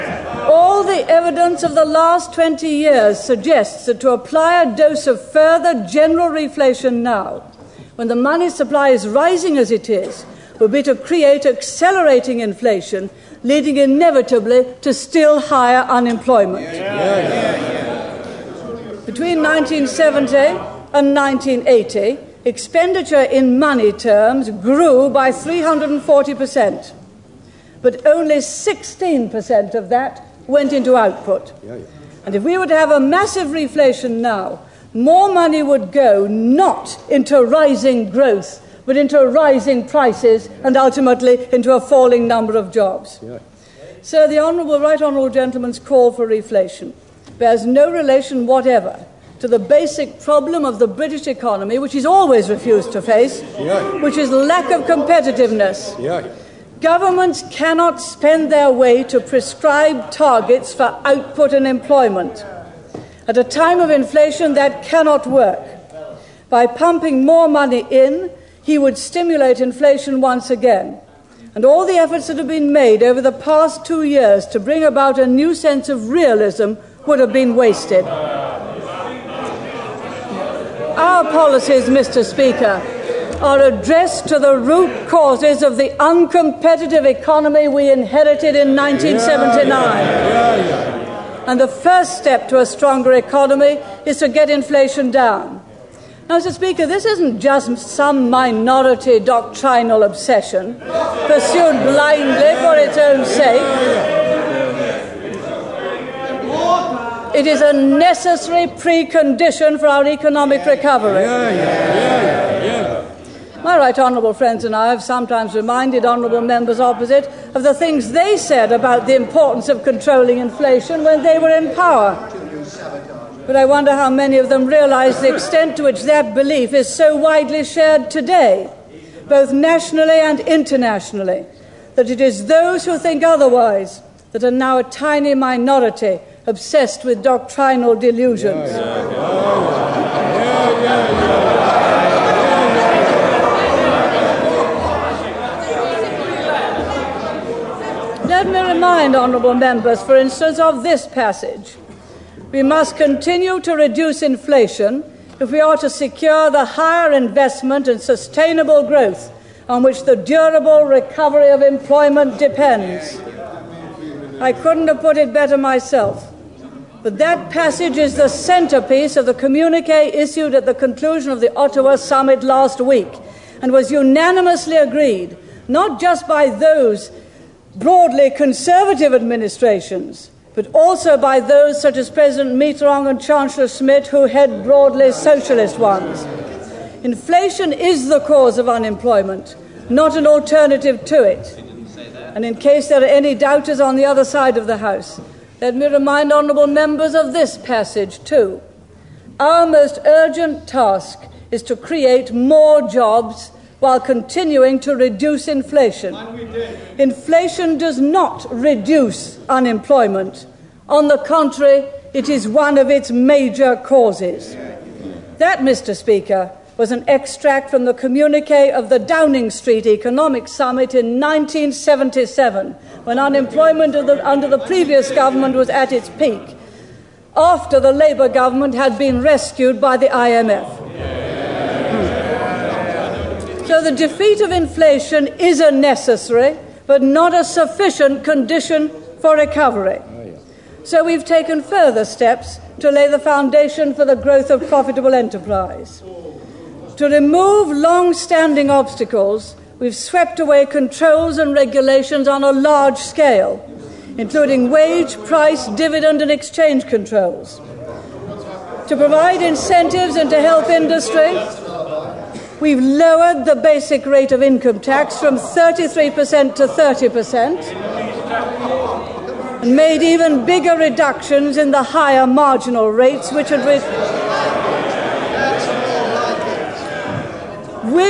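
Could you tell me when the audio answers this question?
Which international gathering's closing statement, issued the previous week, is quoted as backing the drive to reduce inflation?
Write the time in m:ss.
2:51.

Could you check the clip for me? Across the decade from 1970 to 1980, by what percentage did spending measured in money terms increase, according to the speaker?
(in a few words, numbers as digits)
340%.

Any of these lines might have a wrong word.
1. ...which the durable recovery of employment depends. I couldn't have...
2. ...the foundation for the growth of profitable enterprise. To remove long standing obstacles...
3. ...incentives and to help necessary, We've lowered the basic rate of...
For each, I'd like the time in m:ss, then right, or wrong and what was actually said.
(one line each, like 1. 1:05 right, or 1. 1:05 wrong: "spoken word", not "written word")
1. 2:39 right
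2. 4:03 right
3. 4:19 wrong: "industry", not "necessary".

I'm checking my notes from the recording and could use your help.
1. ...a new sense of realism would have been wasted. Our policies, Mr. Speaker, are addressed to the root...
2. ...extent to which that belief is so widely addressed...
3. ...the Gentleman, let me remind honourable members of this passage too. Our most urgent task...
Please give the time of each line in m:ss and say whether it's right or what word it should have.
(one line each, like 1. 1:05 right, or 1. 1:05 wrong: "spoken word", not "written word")
1. 1:15 right
2. 2:05 wrong: "shared", not "addressed"
3. 3:14 wrong: "House", not "Gentleman".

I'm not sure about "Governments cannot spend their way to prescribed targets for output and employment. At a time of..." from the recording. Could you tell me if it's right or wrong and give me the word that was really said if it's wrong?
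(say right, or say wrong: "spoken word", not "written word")
right.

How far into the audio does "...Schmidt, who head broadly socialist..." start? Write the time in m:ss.
3:03.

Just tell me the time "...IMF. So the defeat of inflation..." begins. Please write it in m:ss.
3:50.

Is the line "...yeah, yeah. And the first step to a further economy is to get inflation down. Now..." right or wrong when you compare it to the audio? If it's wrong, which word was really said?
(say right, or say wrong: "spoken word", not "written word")
wrong: "stronger", not "further".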